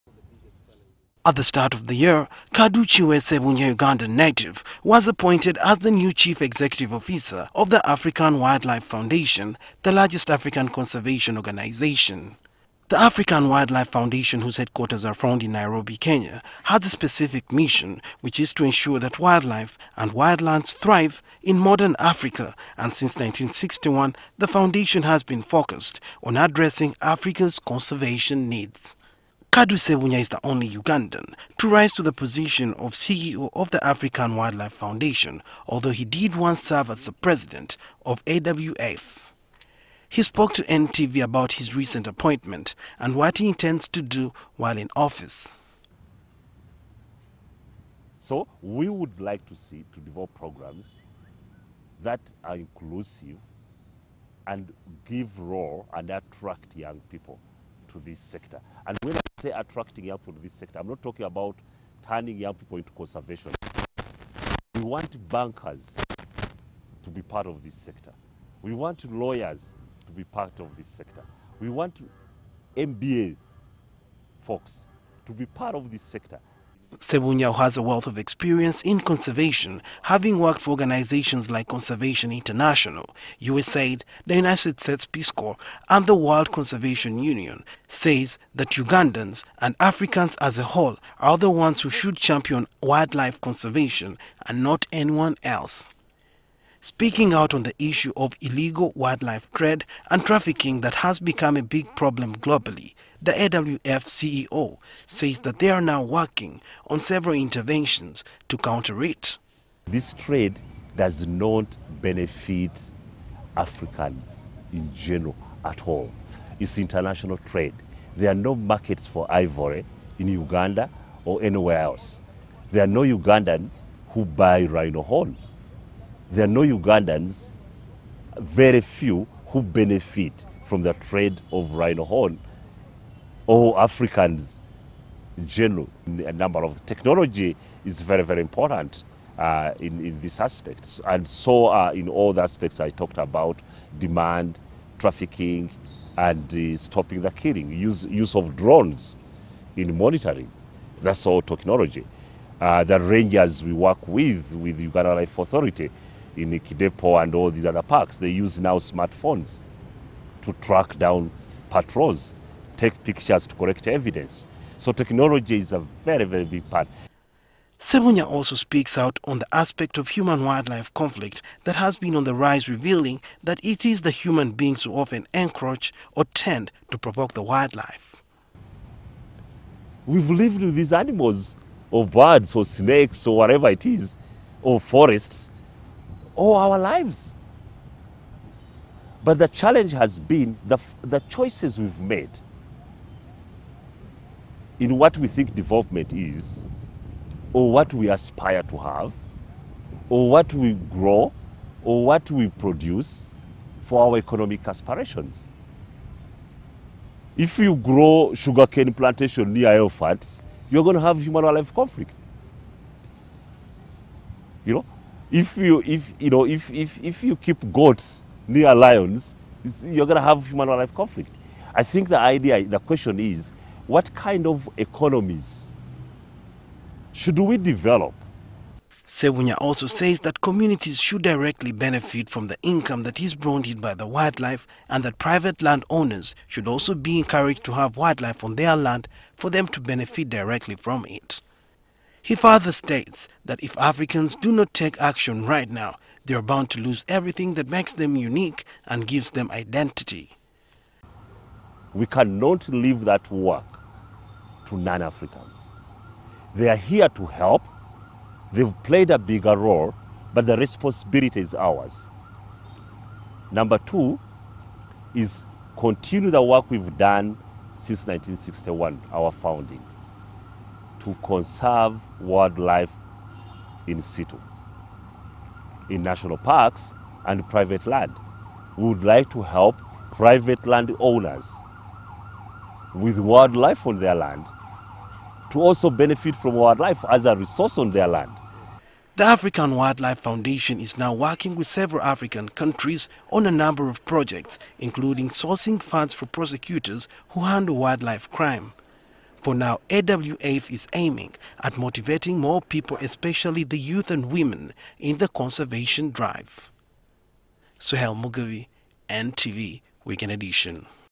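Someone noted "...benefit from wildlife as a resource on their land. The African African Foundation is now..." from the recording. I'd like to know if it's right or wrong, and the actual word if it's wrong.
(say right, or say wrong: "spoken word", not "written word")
wrong: "Wildlife", not "African".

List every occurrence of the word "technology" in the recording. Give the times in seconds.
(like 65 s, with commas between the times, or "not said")
136 s, 151 s, 164 s.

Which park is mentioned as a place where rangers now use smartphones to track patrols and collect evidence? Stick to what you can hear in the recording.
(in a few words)
Kidepo.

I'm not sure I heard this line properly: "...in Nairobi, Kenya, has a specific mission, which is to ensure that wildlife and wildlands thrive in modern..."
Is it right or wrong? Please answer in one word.
right.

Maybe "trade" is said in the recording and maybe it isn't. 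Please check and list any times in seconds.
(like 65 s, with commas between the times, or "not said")
99 s, 110 s, 117 s, 130 s.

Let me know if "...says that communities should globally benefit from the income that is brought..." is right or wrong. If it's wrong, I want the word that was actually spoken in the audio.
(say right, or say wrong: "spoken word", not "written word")
wrong: "directly", not "globally".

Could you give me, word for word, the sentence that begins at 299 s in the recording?
For now, AWF is aiming at motivating more people, especially the youth and women, in the conservation drive.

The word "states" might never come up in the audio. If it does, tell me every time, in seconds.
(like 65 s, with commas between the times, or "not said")
84 s, 242 s.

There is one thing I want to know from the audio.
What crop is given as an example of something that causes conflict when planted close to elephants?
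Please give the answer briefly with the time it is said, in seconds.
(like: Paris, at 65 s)
Sugarcane, at 208 s.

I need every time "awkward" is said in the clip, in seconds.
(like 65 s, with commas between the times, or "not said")
not said.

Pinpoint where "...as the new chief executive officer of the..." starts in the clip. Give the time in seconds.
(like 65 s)
5 s.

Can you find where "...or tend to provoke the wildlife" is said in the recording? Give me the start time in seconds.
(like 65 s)
176 s.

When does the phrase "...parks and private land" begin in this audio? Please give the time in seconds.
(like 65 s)
276 s.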